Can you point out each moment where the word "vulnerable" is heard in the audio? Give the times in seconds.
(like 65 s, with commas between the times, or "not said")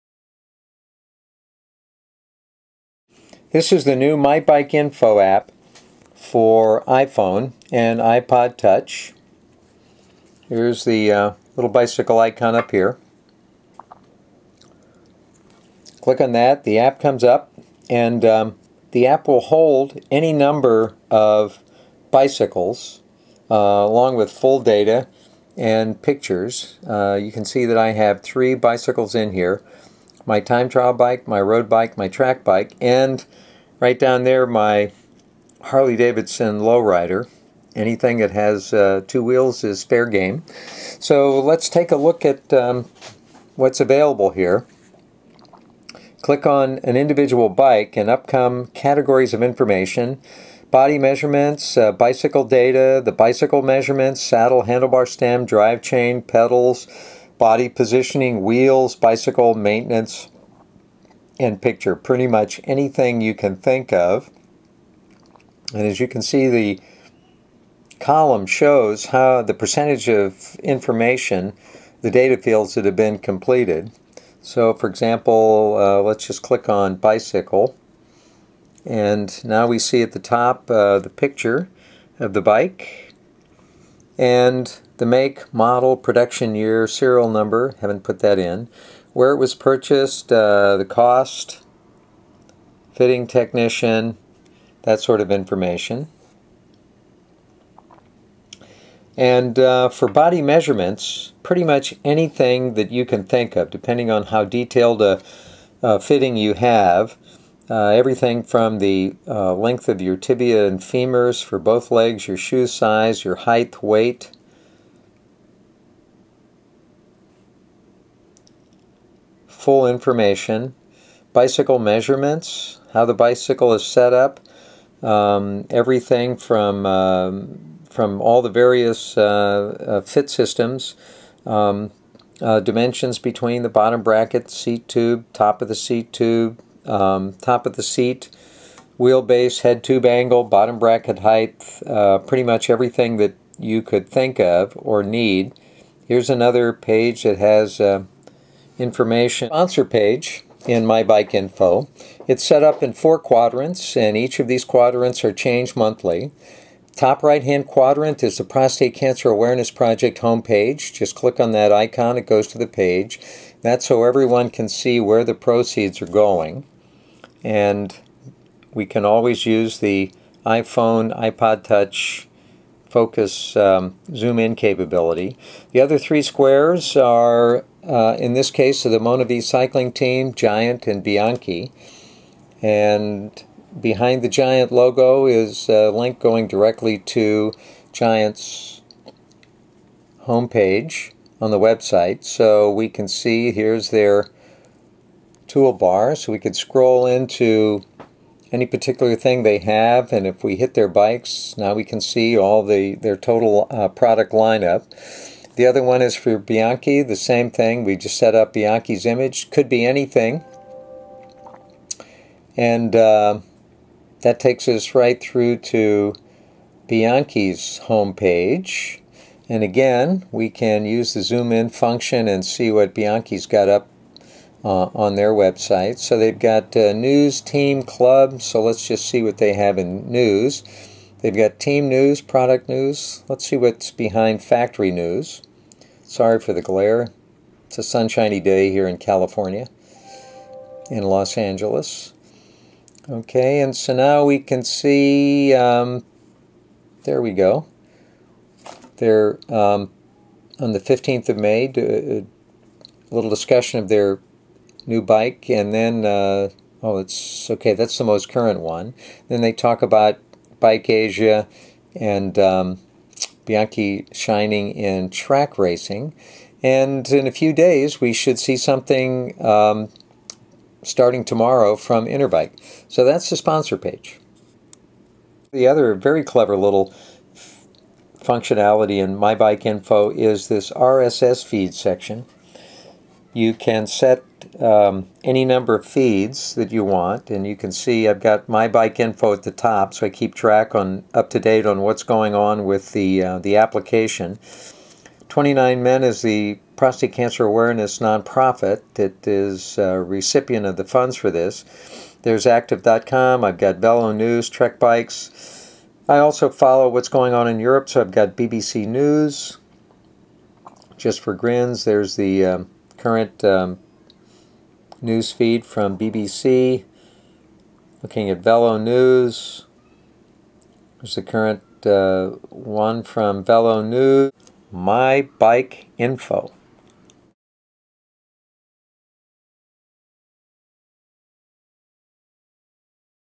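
not said.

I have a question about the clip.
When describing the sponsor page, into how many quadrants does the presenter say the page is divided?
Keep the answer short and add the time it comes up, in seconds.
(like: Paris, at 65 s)
4, at 152 s.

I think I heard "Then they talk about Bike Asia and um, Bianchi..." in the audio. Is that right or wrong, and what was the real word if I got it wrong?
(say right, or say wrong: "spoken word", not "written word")
right.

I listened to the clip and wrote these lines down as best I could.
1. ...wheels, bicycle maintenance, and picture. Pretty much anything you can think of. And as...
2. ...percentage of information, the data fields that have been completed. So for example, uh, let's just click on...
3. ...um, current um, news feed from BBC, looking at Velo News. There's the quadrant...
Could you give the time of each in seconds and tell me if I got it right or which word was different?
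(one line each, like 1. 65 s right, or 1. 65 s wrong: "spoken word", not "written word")
1. 58 s right
2. 69 s right
3. 312 s wrong: "current", not "quadrant".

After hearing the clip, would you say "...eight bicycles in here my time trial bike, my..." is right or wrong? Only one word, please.
wrong.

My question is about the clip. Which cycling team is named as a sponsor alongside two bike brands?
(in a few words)
MonaVie.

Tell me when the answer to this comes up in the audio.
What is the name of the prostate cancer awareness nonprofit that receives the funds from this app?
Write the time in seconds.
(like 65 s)
295 s.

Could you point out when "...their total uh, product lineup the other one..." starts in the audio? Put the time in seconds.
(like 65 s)
202 s.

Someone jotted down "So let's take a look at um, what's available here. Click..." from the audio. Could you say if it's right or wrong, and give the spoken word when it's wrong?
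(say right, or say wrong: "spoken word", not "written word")
right.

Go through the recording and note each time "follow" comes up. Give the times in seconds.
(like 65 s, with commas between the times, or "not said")
306 s.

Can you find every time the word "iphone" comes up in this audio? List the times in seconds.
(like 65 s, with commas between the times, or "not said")
6 s, 170 s.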